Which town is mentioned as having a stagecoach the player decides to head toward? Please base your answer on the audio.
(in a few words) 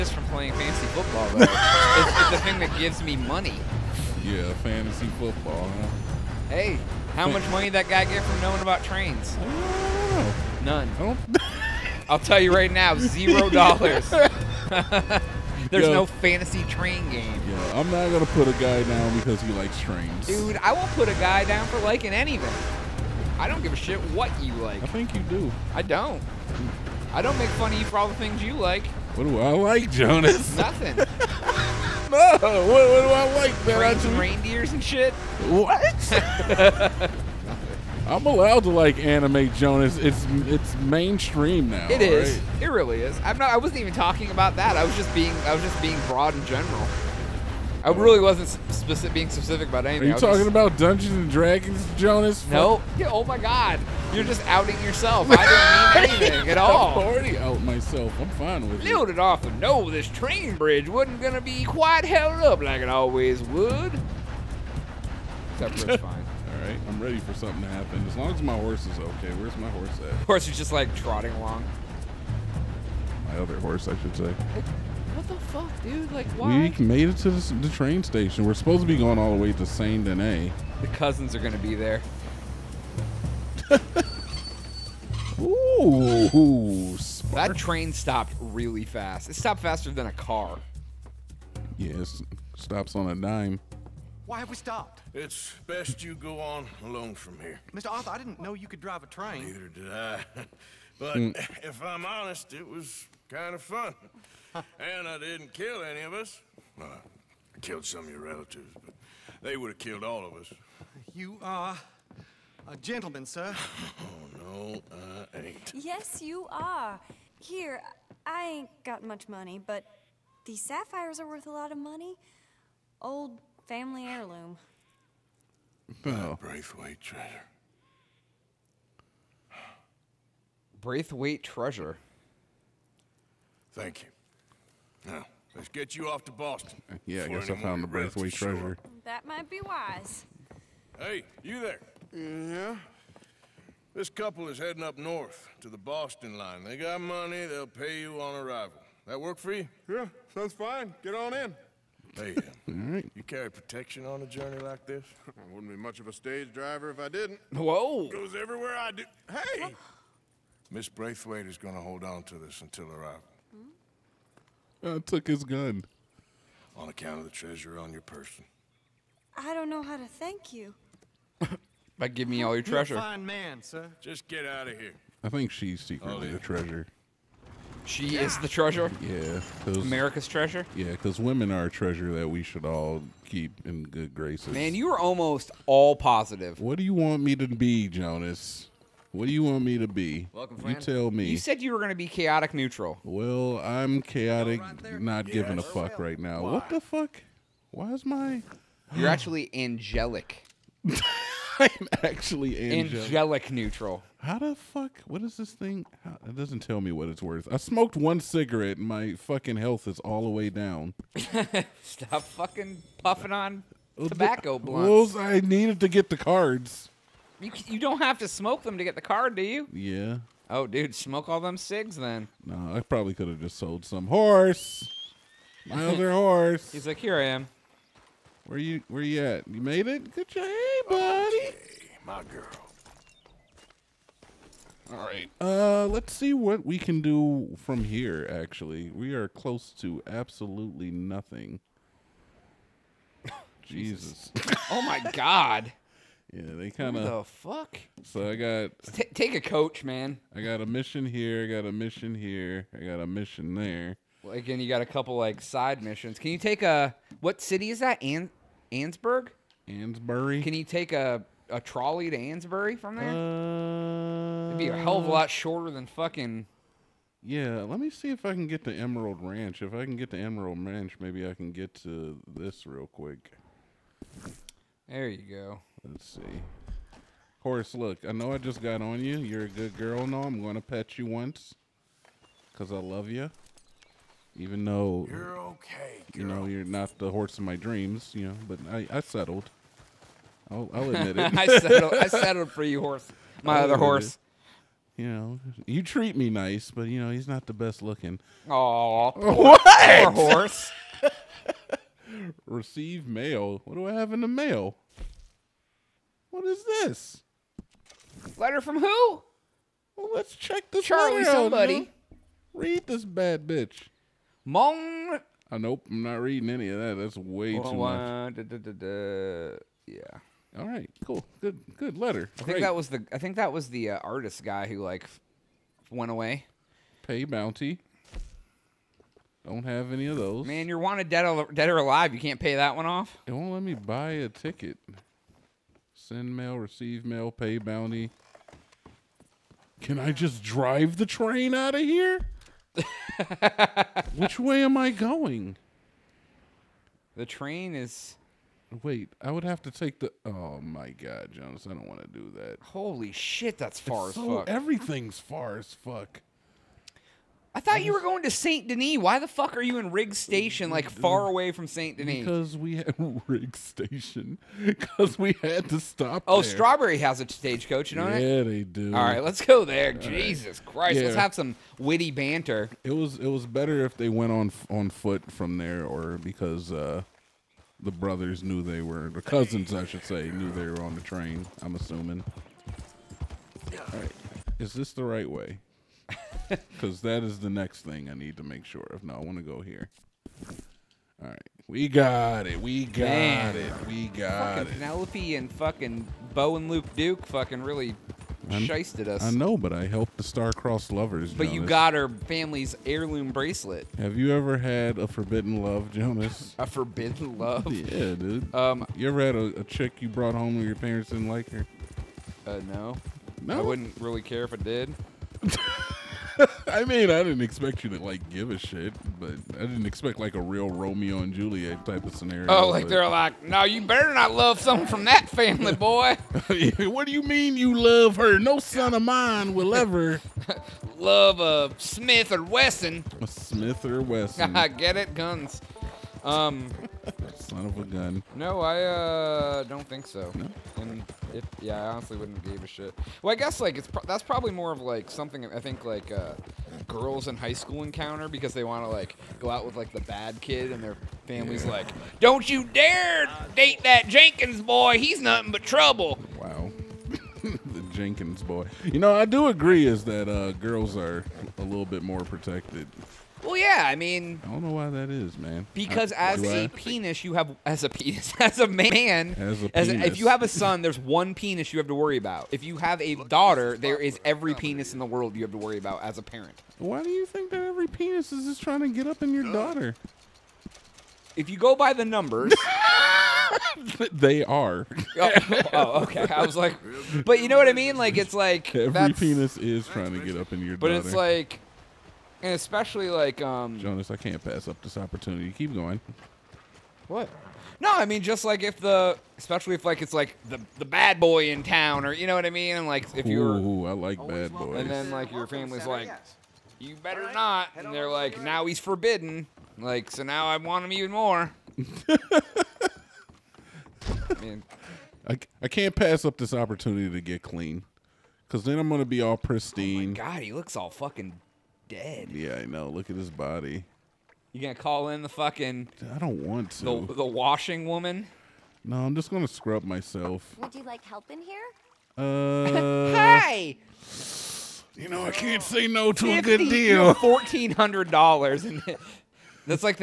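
Strawberry.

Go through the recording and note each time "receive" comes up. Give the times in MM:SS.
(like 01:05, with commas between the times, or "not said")
05:02, 05:36.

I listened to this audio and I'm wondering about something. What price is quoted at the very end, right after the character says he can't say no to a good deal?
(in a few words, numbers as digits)
$1,400.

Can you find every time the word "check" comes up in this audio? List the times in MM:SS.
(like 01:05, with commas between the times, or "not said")
05:10.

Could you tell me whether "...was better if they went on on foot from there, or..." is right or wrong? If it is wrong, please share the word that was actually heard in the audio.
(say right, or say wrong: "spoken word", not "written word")
right.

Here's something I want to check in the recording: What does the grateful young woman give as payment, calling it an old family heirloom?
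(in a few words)
sapphires.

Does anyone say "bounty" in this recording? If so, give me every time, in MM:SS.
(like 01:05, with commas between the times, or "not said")
05:27, 05:37.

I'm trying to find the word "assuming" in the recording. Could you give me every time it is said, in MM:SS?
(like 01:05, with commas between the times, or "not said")
06:21.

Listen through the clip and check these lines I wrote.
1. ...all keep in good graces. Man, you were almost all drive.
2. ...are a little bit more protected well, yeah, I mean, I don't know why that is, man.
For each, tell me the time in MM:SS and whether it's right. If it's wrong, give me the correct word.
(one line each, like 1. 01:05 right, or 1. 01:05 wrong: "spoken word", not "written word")
1. 03:02 wrong: "positive", not "drive"
2. 07:40 right.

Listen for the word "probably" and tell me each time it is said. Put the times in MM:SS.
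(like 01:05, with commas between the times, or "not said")
03:42, 07:24.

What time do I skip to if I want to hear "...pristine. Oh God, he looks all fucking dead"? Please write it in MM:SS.
08:39.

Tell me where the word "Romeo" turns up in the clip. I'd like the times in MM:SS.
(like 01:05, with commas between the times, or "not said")
07:00.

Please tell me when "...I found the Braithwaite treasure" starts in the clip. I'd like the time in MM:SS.
02:17.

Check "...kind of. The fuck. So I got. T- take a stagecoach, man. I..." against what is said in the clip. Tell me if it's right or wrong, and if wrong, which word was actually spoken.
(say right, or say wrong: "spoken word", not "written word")
wrong: "coach", not "stagecoach".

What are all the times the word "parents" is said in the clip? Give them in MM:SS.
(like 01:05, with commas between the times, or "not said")
06:50, 07:56.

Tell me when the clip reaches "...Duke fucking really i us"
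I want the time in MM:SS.
06:36.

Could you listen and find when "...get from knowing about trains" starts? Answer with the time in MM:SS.
00:08.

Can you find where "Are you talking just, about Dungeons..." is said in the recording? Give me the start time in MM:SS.
00:50.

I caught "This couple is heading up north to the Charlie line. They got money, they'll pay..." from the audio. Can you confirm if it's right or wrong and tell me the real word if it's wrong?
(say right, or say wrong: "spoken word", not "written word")
wrong: "Boston", not "Charlie".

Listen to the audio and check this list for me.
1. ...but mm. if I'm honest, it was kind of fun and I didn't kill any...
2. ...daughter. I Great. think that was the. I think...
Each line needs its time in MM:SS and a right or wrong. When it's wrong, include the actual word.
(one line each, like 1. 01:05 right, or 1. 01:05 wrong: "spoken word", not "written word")
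1. 01:40 right
2. 05:21 wrong: "letter", not "daughter".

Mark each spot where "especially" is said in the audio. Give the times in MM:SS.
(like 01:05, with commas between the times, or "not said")
08:12, 08:19.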